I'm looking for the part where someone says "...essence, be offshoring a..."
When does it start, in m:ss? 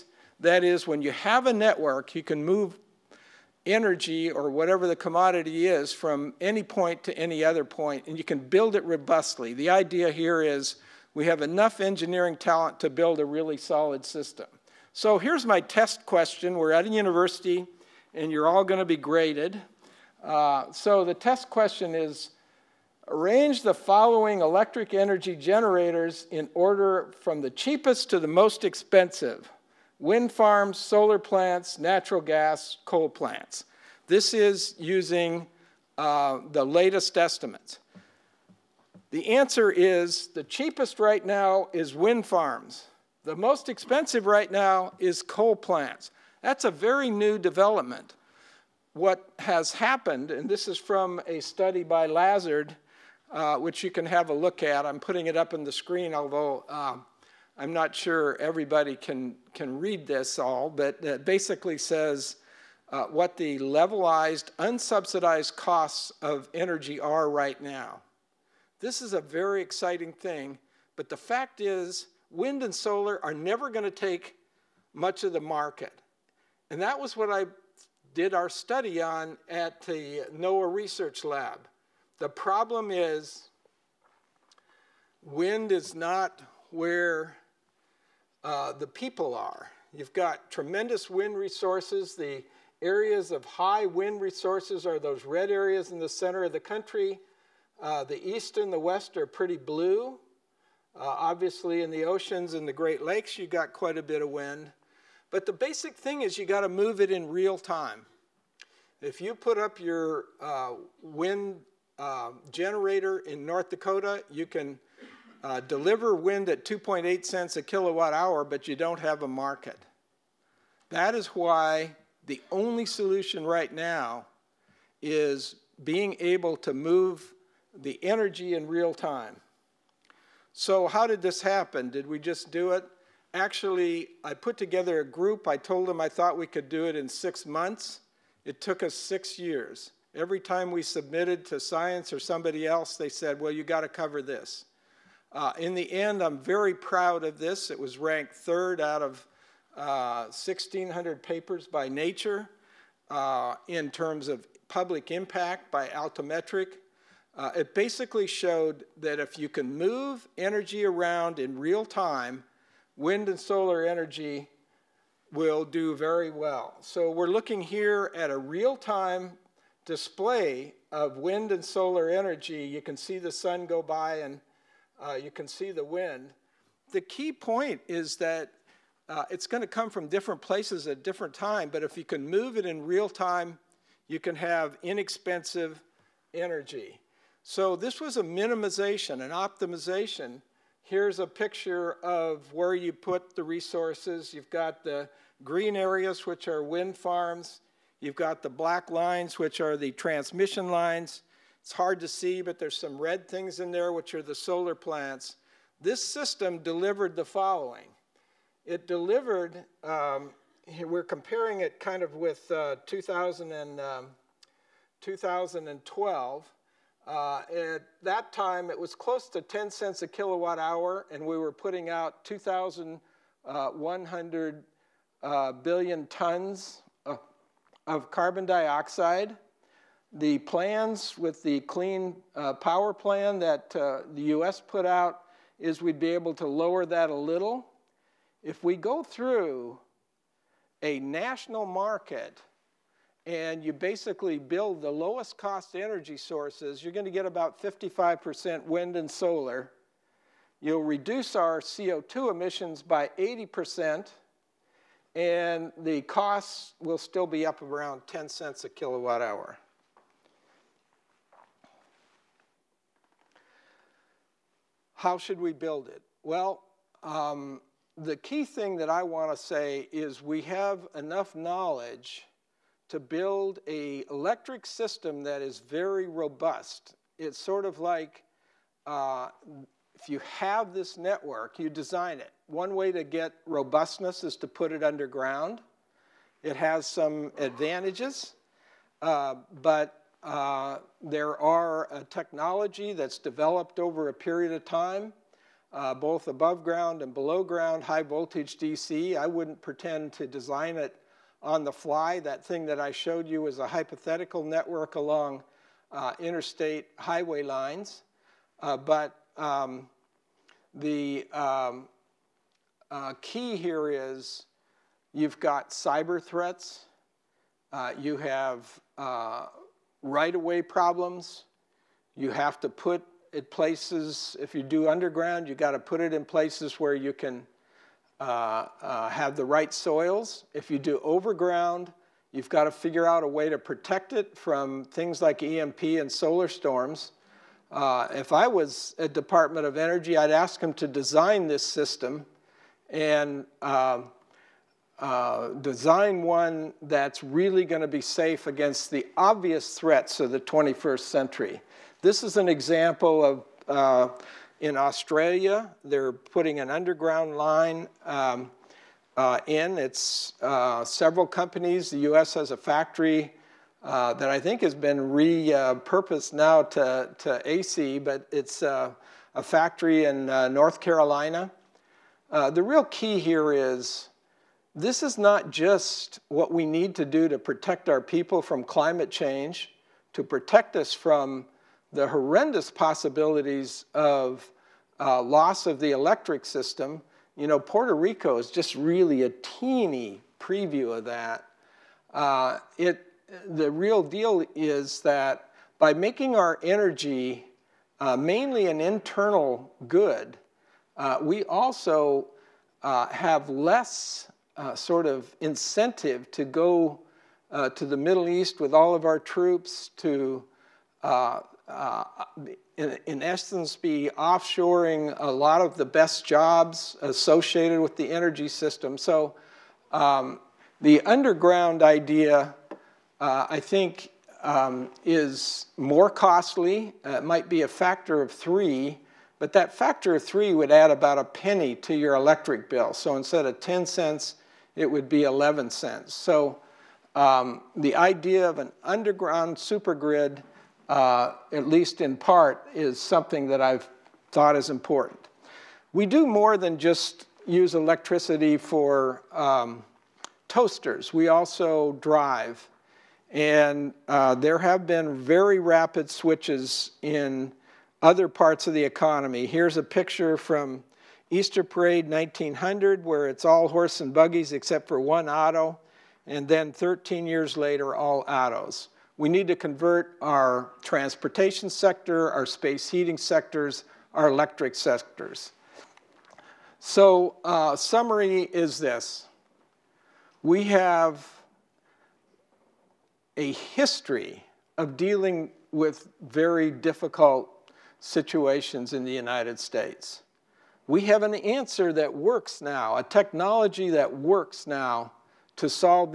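6:53.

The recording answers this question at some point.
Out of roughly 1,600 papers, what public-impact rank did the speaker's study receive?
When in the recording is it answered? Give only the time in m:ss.
2:28.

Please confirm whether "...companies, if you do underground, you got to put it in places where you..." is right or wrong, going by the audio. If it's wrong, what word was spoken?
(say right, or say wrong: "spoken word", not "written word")
wrong: "places", not "companies".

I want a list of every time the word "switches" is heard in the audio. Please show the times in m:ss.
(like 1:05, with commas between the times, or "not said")
7:36.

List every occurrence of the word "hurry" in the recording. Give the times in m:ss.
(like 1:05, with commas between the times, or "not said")
not said.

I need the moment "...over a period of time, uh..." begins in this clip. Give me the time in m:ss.
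4:53.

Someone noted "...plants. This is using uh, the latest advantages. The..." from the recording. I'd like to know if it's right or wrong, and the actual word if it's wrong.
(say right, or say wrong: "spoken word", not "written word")
wrong: "estimates", not "advantages".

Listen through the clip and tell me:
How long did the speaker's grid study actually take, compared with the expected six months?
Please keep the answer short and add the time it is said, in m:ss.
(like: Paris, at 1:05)
6 years, at 2:18.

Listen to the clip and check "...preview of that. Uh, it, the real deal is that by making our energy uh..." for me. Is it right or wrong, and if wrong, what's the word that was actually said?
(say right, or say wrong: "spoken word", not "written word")
right.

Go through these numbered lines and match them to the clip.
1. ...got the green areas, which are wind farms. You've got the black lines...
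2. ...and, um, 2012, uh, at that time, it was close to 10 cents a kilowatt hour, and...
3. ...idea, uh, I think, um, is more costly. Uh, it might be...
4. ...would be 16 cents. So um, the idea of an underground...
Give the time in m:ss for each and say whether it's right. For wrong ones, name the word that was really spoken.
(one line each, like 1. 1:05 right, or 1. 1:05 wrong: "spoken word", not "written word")
1. 3:14 right
2. 3:33 right
3. 7:01 right
4. 7:14 wrong: "11", not "16".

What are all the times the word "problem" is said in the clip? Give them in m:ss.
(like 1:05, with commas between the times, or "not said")
1:22, 5:20.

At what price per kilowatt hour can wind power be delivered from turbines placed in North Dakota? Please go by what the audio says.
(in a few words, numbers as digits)
2.8 cents.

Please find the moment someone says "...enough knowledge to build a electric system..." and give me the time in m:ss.
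4:30.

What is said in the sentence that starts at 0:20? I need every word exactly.
Uh, so the test question is, arrange the following electric energy generators in order from the cheapest to the most expensive.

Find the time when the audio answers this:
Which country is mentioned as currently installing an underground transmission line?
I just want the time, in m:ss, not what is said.
5:54.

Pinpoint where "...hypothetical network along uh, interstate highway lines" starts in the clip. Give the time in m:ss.
5:03.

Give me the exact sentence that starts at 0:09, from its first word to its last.
The idea here is we have enough engineering talent to build a really solid system.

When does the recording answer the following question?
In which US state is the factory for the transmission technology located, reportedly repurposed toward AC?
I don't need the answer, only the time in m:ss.
6:10.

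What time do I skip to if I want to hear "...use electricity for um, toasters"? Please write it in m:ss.
7:27.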